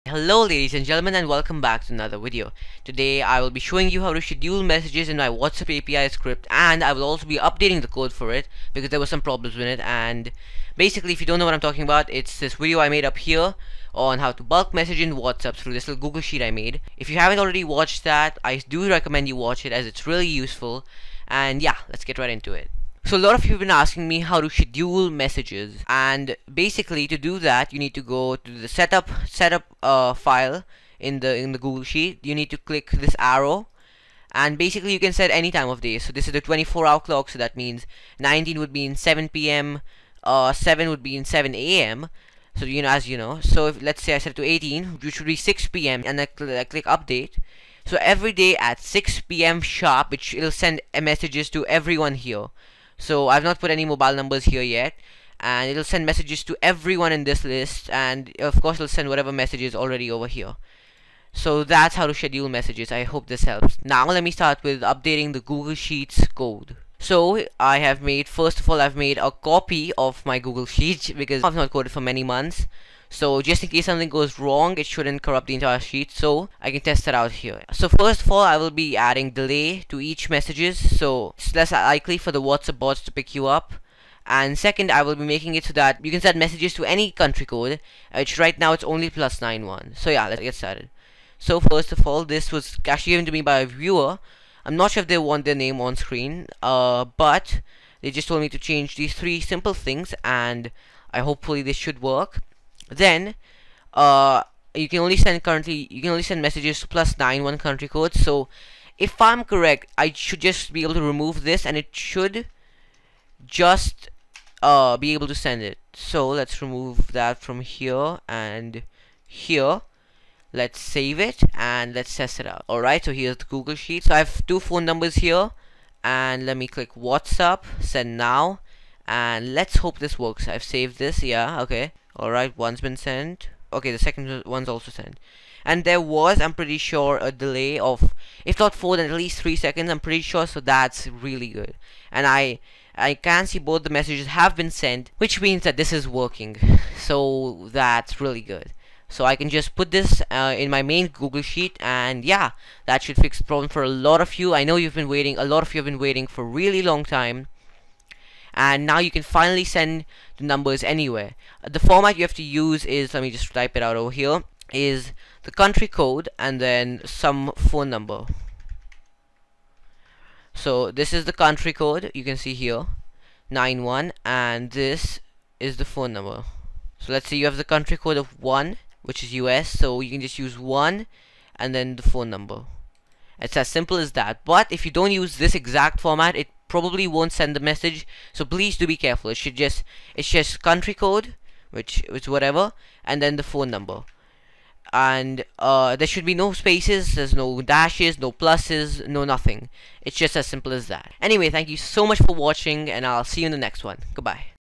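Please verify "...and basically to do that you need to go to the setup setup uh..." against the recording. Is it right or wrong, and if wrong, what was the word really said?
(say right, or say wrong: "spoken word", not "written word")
right.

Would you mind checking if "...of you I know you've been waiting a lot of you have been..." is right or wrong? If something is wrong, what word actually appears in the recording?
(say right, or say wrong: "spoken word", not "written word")
right.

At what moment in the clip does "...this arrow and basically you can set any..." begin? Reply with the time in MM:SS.
00:32.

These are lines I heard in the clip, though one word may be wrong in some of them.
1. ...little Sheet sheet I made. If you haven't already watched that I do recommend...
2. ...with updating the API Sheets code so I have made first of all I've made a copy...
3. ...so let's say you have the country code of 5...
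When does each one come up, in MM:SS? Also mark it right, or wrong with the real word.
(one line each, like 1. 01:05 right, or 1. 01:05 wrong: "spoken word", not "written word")
1. 00:15 wrong: "Google", not "Sheet"
2. 01:04 wrong: "Google", not "API"
3. 02:56 wrong: "1", not "5".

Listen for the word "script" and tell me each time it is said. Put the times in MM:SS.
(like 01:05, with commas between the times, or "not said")
00:06.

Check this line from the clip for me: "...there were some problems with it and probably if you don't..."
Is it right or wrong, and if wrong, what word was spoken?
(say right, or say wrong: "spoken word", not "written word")
wrong: "basically", not "probably".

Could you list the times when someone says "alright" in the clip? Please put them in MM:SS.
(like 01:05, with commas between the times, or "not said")
02:02, 02:12.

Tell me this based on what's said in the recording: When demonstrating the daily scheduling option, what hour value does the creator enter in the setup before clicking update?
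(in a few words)
18.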